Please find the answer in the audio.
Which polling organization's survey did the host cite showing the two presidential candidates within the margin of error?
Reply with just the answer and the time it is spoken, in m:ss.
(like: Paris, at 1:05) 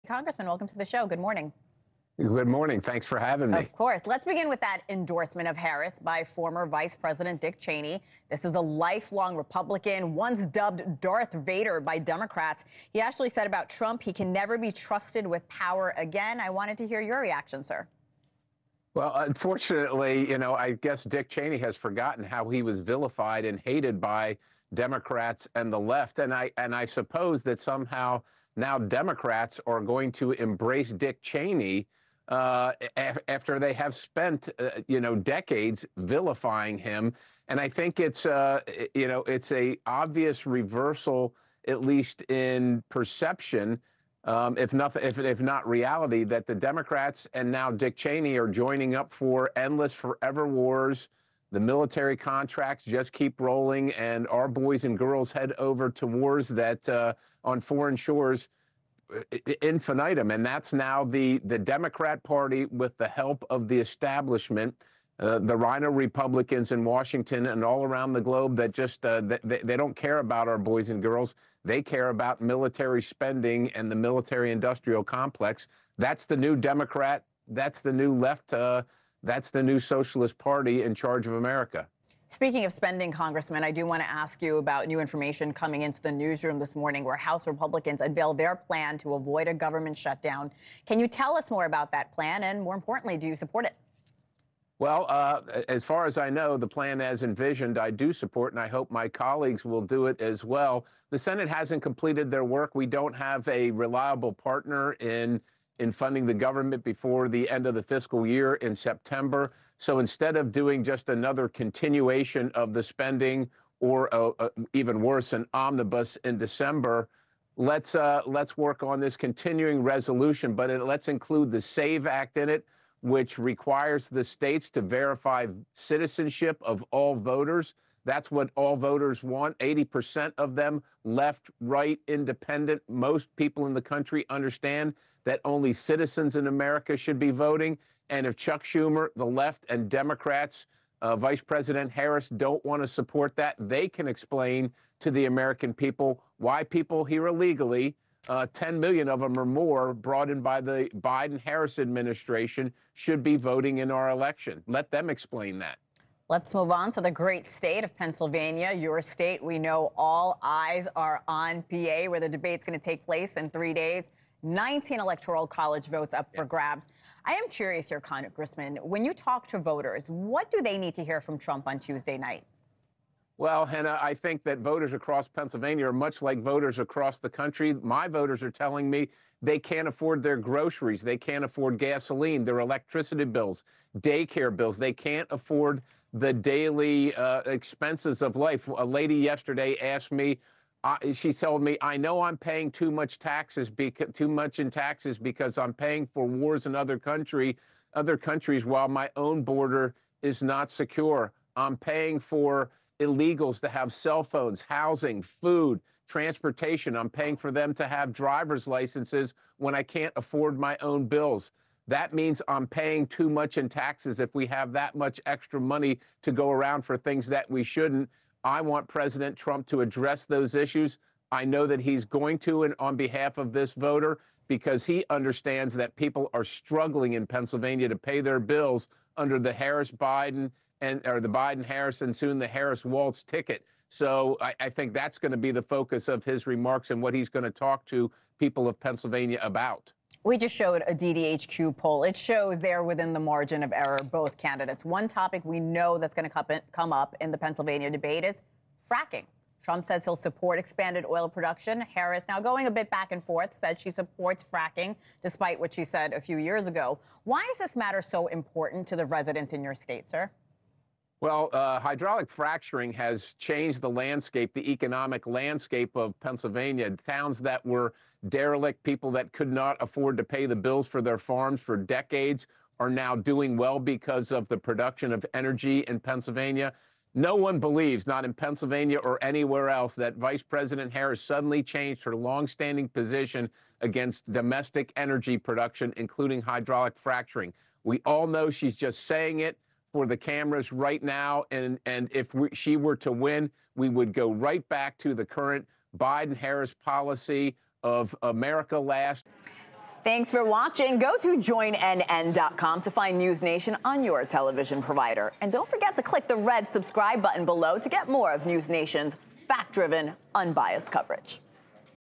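DDHQ, at 4:00.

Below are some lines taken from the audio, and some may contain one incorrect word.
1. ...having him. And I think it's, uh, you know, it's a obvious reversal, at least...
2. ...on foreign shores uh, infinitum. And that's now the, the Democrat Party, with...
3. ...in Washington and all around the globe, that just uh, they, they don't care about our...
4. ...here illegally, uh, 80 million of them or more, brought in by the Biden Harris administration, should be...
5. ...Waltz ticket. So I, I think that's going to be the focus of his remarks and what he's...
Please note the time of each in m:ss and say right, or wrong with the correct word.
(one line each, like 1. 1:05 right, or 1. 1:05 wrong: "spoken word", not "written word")
1. 0:35 wrong: "vilifying", not "having"
2. 0:57 right
3. 1:06 right
4. 2:27 wrong: "10", not "80"
5. 3:52 right.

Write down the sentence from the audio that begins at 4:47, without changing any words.
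We all know she's just saying it for the cameras right now.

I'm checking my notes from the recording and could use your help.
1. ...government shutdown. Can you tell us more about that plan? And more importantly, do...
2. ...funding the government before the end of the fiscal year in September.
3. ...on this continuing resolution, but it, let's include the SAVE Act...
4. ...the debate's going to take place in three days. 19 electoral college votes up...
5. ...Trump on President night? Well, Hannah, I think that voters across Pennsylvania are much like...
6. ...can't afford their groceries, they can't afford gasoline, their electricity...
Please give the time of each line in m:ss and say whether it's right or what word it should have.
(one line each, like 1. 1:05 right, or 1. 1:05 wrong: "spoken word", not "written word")
1. 1:29 right
2. 1:45 right
3. 1:58 right
4. 2:42 right
5. 2:51 wrong: "Tuesday", not "President"
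6. 2:59 right.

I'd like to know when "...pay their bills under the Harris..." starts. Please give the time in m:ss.
3:47.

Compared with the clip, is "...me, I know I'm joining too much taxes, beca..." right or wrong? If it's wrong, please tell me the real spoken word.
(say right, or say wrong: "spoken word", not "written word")
wrong: "paying", not "joining".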